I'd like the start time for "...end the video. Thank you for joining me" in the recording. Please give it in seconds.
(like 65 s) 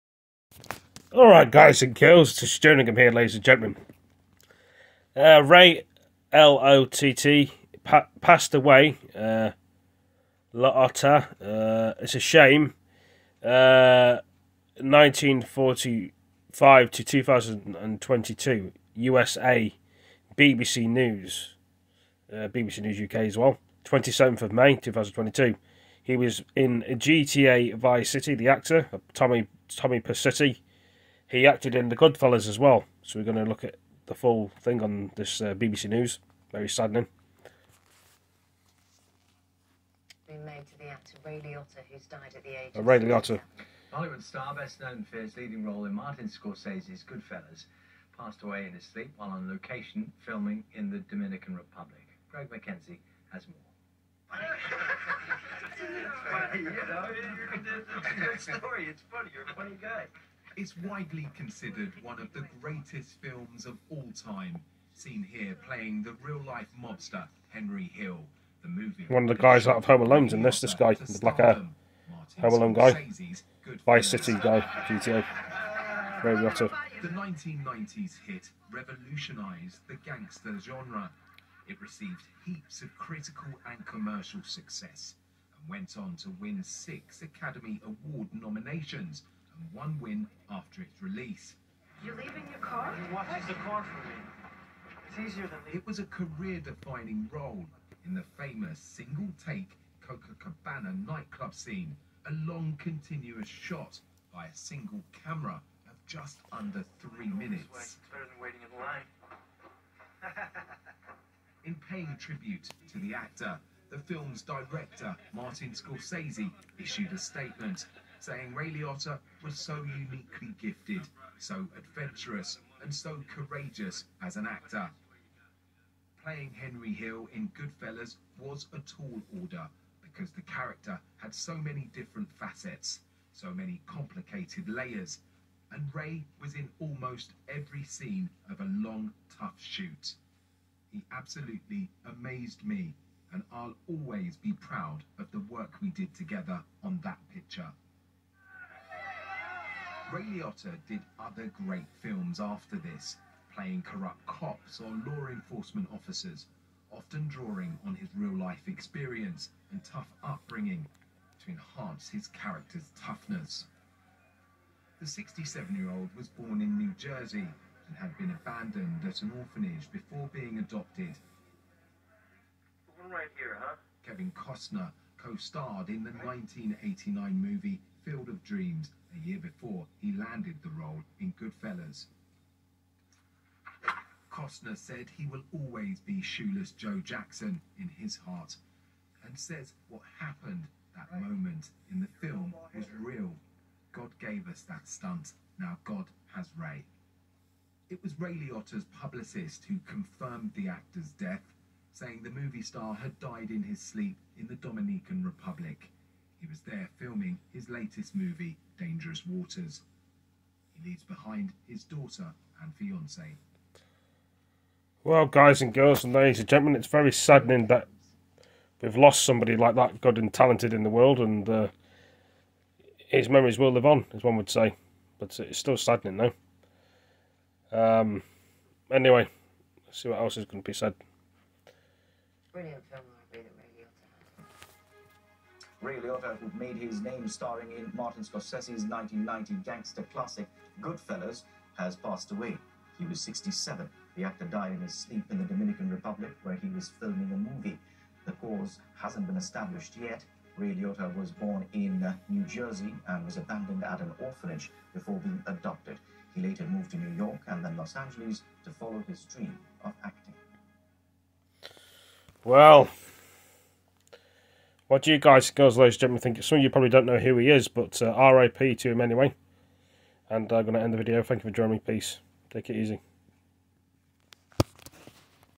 270 s.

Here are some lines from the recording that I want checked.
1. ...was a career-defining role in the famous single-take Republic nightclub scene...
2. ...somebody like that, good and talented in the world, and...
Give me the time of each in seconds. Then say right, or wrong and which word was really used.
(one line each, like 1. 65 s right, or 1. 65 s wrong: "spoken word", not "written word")
1. 95 s wrong: "Copacabana", not "Republic"
2. 219 s right.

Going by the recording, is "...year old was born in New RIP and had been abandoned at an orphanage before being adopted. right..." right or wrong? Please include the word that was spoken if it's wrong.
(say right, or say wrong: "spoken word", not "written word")
wrong: "Jersey", not "RIP".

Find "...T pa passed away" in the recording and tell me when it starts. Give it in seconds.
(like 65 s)
7 s.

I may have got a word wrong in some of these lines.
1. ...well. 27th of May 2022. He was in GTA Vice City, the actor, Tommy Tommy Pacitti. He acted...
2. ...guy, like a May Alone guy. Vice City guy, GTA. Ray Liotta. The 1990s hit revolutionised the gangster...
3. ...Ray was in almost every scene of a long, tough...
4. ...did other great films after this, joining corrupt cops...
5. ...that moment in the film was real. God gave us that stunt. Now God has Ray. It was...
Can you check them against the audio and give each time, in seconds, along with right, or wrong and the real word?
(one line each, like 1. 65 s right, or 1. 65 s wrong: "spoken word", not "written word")
1. 23 s right
2. 70 s wrong: "Home", not "May"
3. 135 s right
4. 150 s wrong: "playing", not "joining"
5. 190 s right.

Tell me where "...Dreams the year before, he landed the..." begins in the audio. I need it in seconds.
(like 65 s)
178 s.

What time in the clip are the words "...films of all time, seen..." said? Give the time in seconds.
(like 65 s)
63 s.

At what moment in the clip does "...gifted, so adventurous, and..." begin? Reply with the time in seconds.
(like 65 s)
120 s.